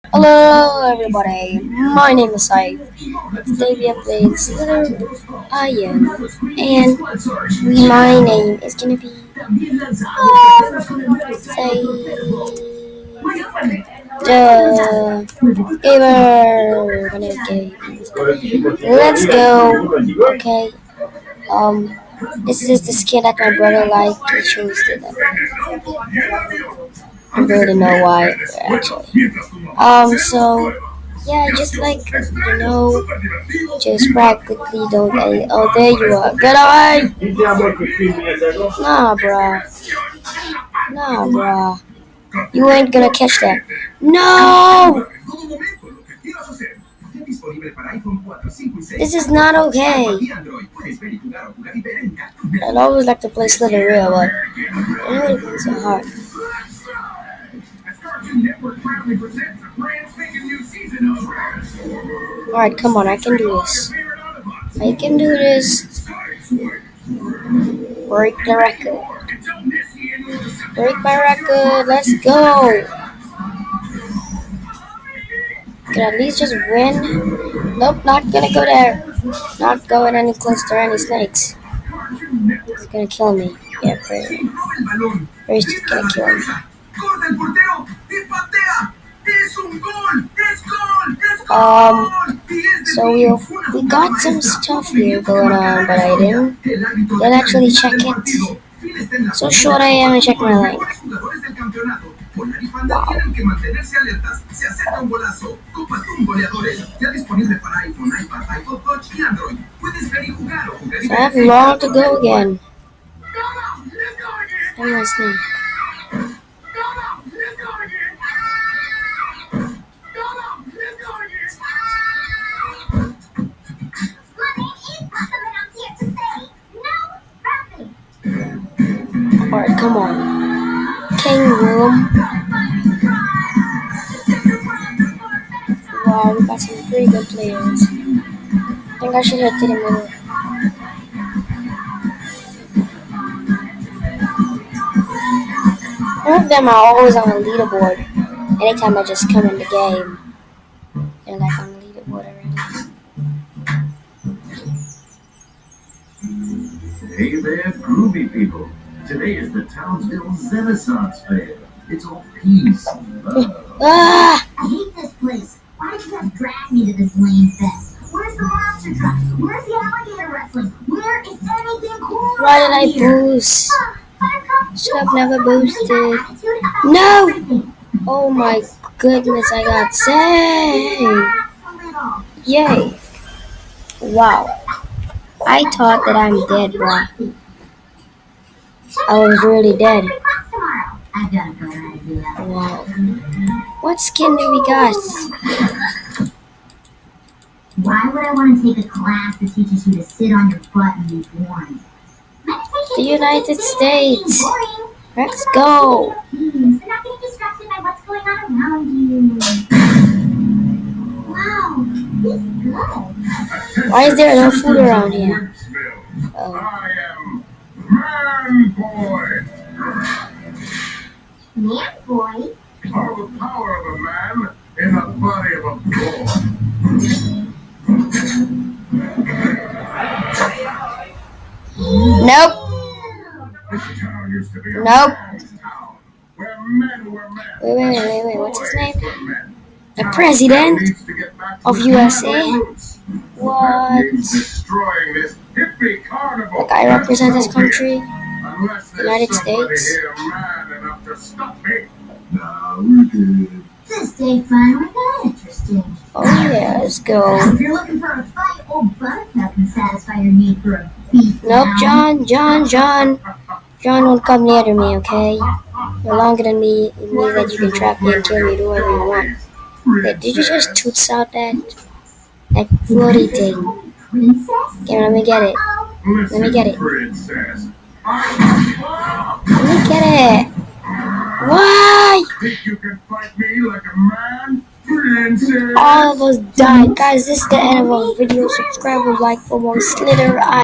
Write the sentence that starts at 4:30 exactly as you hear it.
Wait, did you just toots out that, that floaty thing?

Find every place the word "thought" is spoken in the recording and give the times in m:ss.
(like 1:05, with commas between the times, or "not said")
3:05.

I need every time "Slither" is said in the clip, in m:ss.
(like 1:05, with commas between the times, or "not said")
0:04, 0:53, 4:49.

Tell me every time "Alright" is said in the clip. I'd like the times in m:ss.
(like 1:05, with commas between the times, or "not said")
1:02, 2:09.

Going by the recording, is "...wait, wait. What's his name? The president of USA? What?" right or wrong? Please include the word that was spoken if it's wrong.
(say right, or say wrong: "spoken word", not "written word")
right.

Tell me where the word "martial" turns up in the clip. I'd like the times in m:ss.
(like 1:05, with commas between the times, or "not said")
not said.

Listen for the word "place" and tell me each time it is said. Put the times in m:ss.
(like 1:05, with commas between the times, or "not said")
2:45.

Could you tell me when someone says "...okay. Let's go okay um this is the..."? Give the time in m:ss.
0:17.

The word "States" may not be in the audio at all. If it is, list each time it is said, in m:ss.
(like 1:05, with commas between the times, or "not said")
3:23, 4:09.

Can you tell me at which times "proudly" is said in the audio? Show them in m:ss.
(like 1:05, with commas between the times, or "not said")
0:58.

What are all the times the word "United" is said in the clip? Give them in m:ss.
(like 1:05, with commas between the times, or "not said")
3:23, 4:08.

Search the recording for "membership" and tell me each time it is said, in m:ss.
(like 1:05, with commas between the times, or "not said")
not said.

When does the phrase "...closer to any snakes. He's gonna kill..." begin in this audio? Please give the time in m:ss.
1:20.